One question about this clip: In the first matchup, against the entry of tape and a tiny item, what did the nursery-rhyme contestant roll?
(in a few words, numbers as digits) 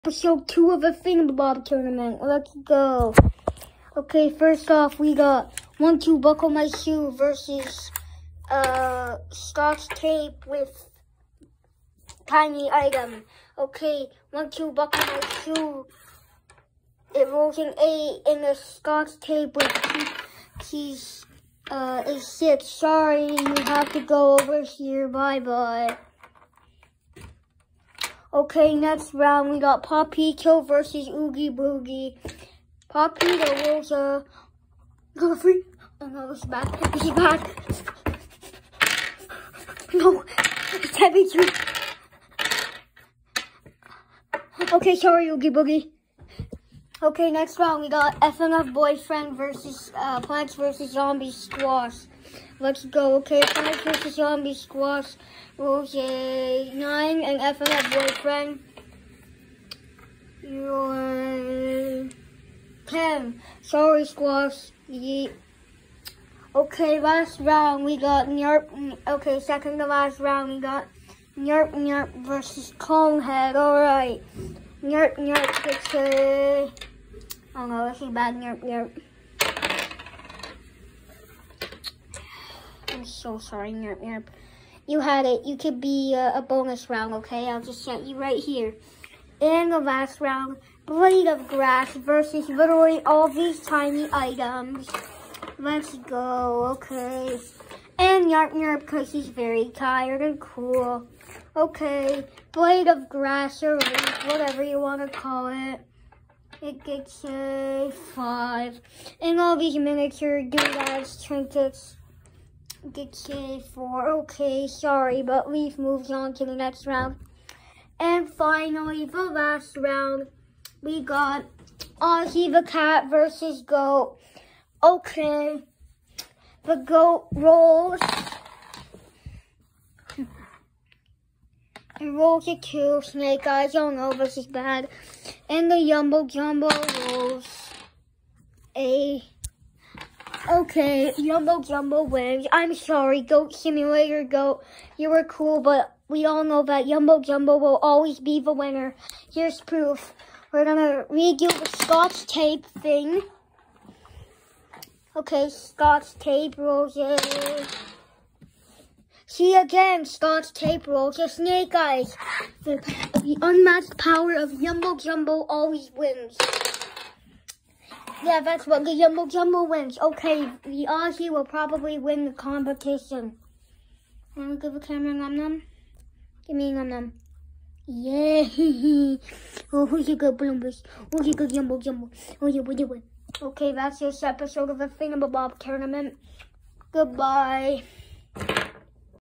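8.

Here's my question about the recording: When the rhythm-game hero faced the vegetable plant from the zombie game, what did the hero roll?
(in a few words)
10.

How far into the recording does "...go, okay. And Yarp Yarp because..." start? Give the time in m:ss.
1:35.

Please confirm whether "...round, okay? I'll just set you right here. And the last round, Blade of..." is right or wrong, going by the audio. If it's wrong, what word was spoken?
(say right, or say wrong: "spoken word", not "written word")
right.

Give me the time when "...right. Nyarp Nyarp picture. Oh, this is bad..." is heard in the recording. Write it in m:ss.
1:13.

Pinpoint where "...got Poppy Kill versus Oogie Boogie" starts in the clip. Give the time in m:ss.
0:29.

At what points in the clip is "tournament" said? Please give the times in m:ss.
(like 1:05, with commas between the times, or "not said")
0:01, 3:05.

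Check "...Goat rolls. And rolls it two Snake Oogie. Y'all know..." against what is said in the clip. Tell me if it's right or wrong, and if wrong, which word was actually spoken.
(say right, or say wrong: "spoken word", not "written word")
wrong: "Eyes", not "Oogie".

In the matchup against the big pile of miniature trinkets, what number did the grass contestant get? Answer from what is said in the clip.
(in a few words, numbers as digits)
5.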